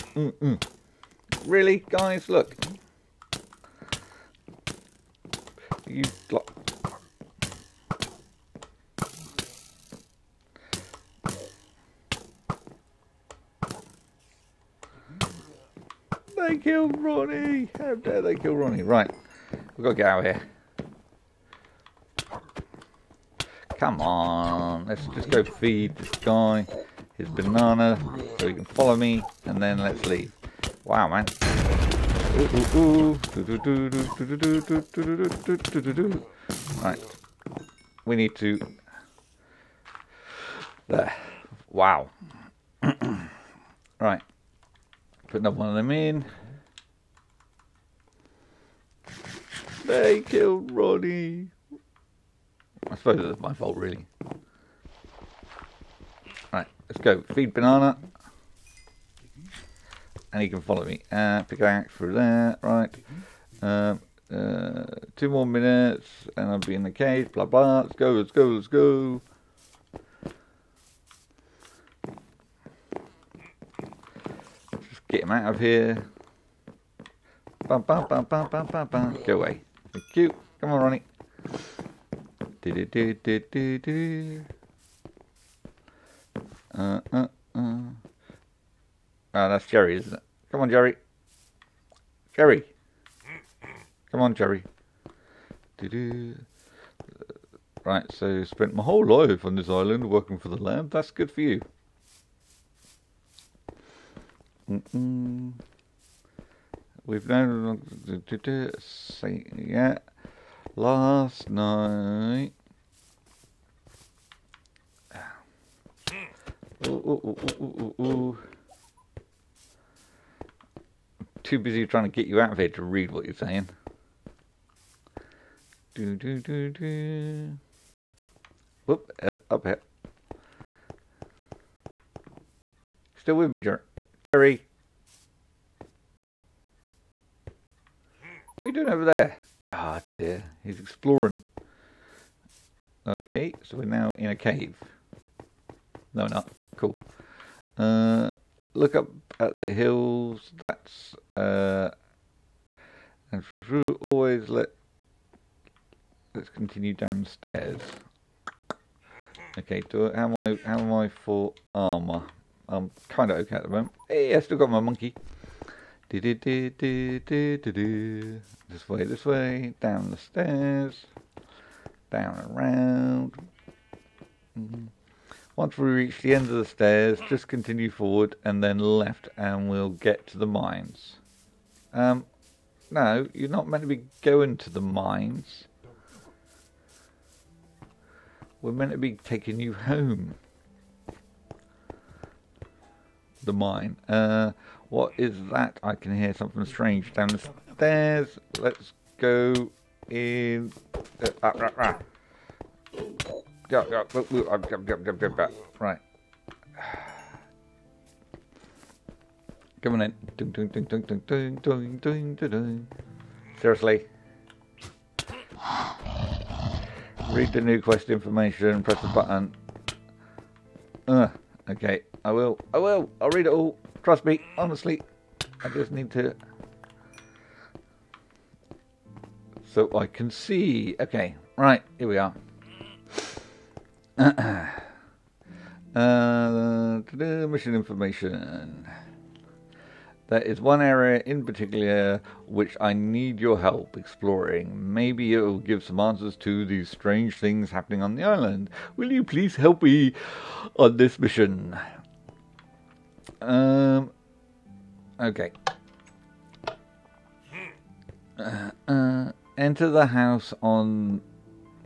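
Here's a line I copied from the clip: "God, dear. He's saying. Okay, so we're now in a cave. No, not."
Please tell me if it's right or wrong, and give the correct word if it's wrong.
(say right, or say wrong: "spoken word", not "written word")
wrong: "exploring", not "saying".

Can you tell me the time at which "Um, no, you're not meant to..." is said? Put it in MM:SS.
03:01.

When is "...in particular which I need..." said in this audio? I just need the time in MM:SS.
04:01.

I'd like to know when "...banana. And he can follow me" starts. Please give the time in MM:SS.
00:57.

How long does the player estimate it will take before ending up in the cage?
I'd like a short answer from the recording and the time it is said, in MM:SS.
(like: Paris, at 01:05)
2 minutes, at 01:05.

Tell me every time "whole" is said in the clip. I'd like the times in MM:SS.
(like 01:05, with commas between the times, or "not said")
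01:38.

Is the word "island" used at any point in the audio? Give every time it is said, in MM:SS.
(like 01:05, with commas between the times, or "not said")
01:39, 04:08.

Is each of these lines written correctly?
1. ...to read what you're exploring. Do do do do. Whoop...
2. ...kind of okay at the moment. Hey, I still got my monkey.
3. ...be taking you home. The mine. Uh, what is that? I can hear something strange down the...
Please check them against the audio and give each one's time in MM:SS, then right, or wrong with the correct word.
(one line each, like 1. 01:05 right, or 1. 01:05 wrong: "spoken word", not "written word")
1. 02:02 wrong: "saying", not "exploring"
2. 02:43 right
3. 03:08 right.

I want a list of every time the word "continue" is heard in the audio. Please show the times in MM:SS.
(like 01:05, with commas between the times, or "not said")
02:36, 02:57.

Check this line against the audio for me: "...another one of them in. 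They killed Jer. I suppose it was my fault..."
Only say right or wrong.
wrong.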